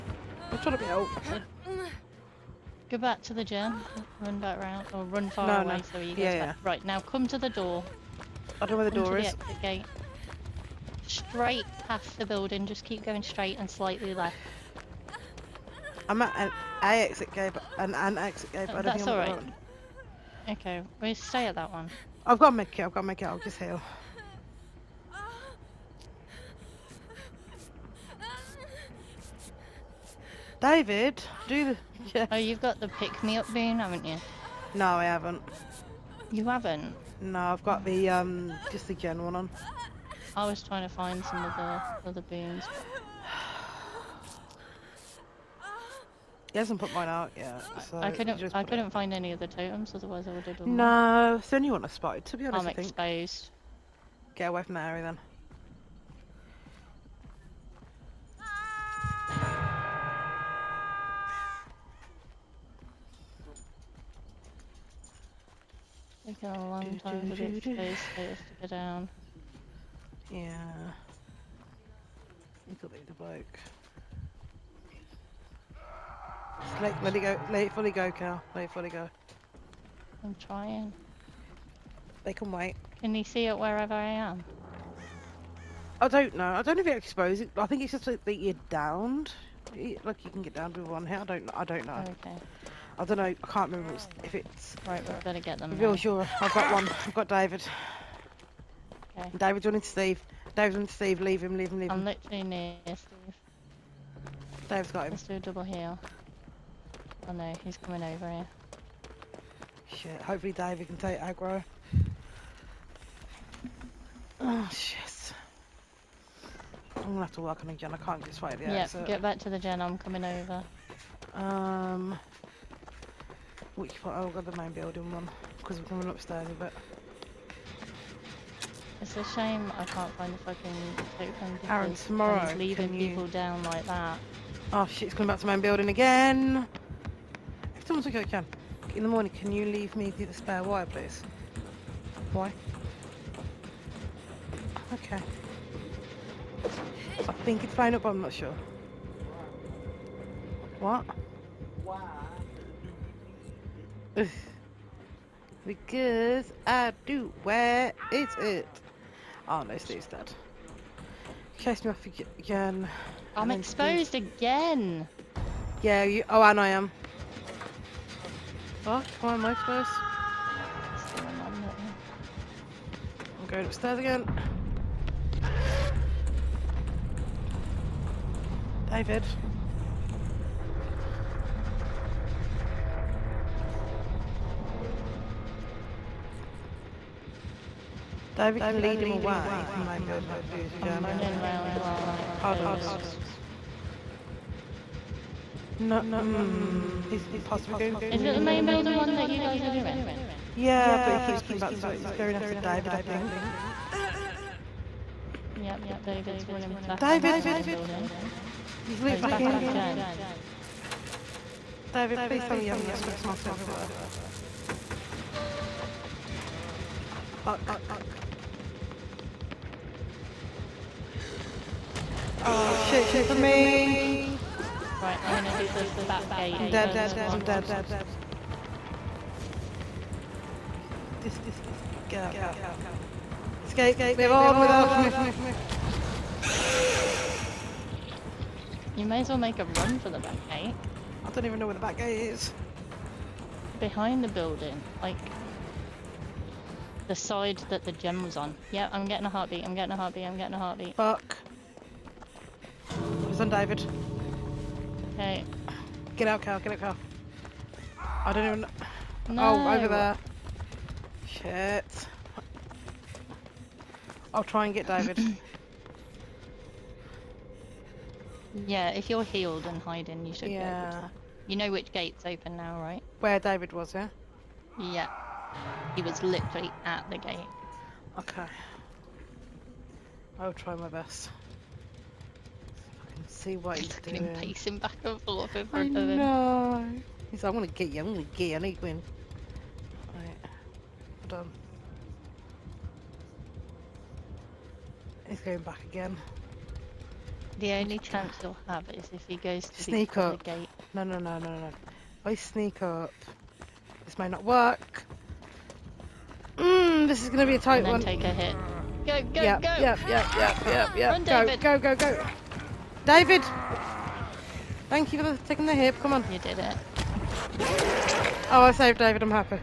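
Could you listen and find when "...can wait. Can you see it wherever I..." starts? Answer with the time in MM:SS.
01:22.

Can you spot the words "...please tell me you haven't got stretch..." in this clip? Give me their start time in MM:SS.
03:32.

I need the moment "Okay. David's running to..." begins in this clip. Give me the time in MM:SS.
01:39.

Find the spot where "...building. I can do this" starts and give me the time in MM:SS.
03:10.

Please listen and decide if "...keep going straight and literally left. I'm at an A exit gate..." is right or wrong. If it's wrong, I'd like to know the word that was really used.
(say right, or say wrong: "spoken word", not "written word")
wrong: "slightly", not "literally".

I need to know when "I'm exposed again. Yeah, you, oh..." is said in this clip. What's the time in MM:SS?
02:43.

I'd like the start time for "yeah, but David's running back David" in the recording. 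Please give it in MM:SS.
03:25.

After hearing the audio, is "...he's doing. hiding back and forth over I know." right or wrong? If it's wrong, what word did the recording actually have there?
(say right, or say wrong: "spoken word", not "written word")
wrong: "pacing", not "hiding".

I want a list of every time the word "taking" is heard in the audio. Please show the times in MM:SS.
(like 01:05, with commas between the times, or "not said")
01:06, 05:15.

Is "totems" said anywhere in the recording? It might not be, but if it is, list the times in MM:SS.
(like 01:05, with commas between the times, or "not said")
00:49.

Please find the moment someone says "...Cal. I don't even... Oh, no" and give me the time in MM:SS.
04:16.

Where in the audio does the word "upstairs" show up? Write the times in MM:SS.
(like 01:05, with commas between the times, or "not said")
02:06, 02:53.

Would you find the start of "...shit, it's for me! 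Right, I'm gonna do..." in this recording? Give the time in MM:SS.
03:42.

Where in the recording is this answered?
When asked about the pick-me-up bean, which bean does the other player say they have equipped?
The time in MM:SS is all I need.
00:38.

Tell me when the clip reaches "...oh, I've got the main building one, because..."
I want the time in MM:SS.
02:04.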